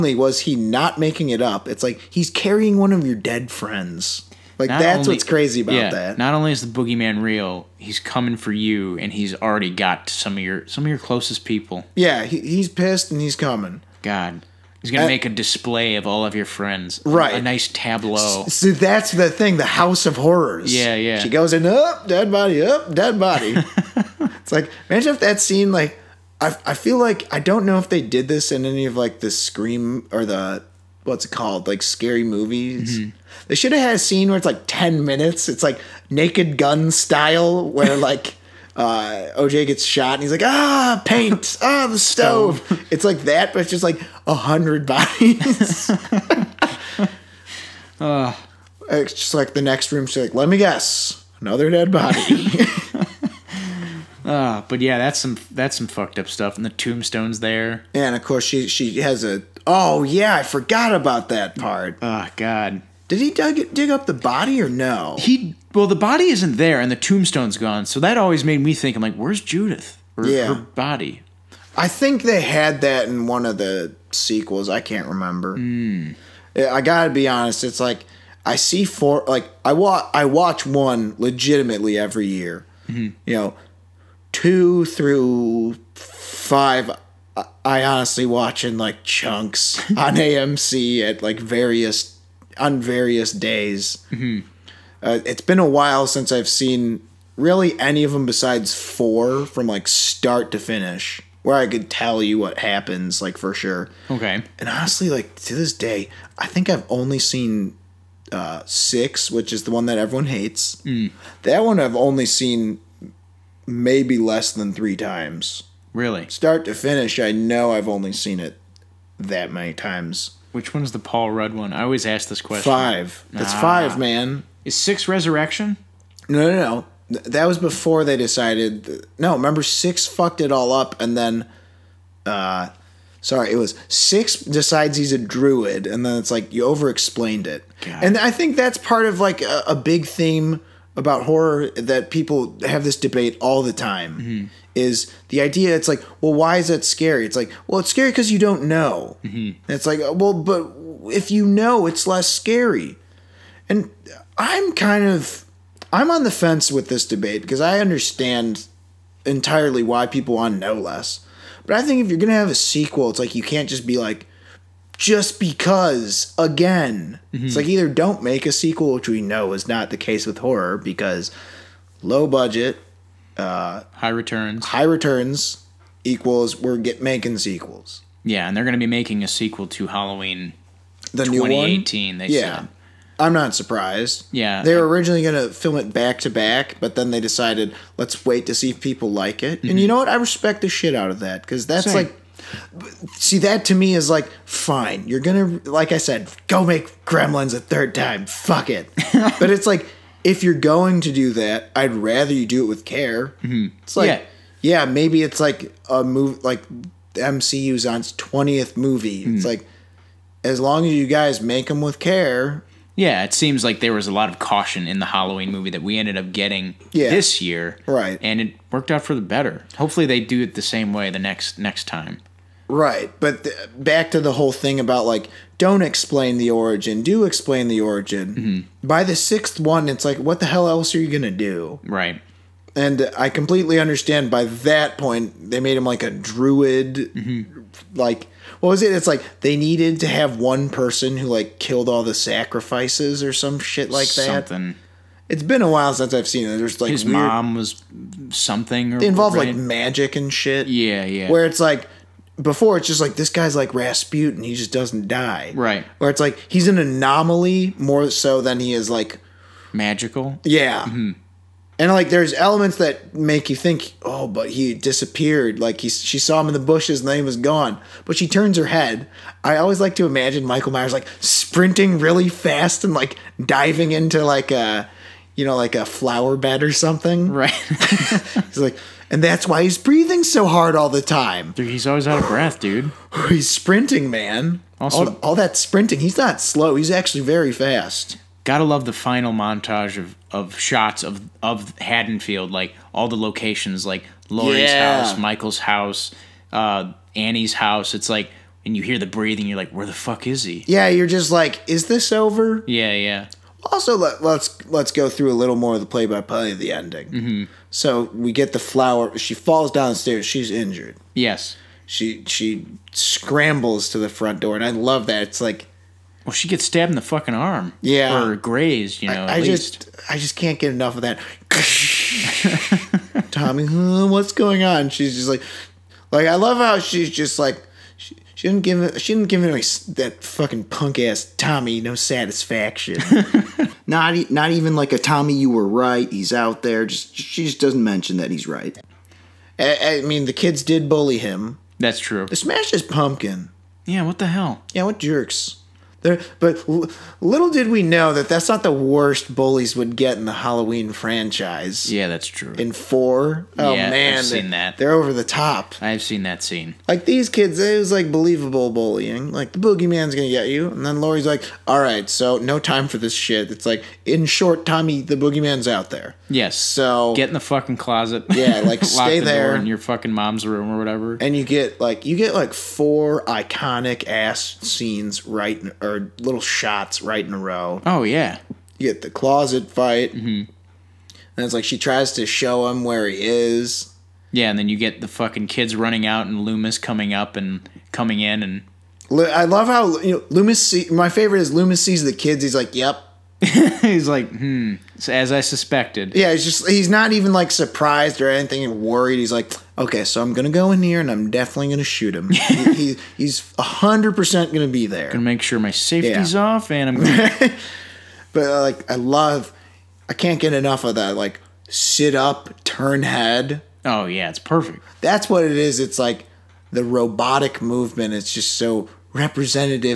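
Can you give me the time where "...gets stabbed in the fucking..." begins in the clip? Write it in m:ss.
5:16.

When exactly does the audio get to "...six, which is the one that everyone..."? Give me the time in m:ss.
1:48.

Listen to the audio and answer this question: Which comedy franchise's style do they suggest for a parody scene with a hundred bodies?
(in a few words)
Naked Gun.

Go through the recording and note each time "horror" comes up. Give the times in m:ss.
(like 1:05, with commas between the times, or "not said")
0:20, 2:21, 2:50.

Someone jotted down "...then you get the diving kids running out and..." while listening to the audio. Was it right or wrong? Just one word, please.
wrong.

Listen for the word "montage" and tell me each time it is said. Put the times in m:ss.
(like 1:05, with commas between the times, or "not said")
4:49.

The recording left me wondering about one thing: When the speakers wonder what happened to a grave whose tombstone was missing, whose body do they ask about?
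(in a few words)
Judith.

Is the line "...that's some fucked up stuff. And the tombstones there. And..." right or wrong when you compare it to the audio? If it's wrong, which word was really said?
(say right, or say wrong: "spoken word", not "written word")
right.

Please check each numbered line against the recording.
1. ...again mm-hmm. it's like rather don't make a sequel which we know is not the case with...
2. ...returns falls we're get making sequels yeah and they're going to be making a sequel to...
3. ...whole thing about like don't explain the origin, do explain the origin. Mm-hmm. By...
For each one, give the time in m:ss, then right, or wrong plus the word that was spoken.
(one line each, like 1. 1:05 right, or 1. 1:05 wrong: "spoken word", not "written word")
1. 2:46 wrong: "either", not "rather"
2. 2:54 wrong: "equals", not "falls"
3. 3:44 right.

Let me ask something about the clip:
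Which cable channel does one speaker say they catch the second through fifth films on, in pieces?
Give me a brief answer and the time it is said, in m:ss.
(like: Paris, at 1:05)
AMC, at 1:30.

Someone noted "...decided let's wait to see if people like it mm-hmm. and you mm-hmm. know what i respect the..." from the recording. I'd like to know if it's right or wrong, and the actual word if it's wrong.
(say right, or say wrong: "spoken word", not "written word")
right.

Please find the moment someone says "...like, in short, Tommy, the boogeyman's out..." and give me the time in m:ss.
6:03.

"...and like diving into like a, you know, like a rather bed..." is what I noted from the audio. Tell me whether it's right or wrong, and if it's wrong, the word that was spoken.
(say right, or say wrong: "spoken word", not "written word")
wrong: "flower", not "rather".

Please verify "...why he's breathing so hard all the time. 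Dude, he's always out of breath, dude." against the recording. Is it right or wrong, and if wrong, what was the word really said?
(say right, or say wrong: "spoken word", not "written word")
right.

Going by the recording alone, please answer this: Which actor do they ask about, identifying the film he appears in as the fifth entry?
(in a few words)
Paul Rudd.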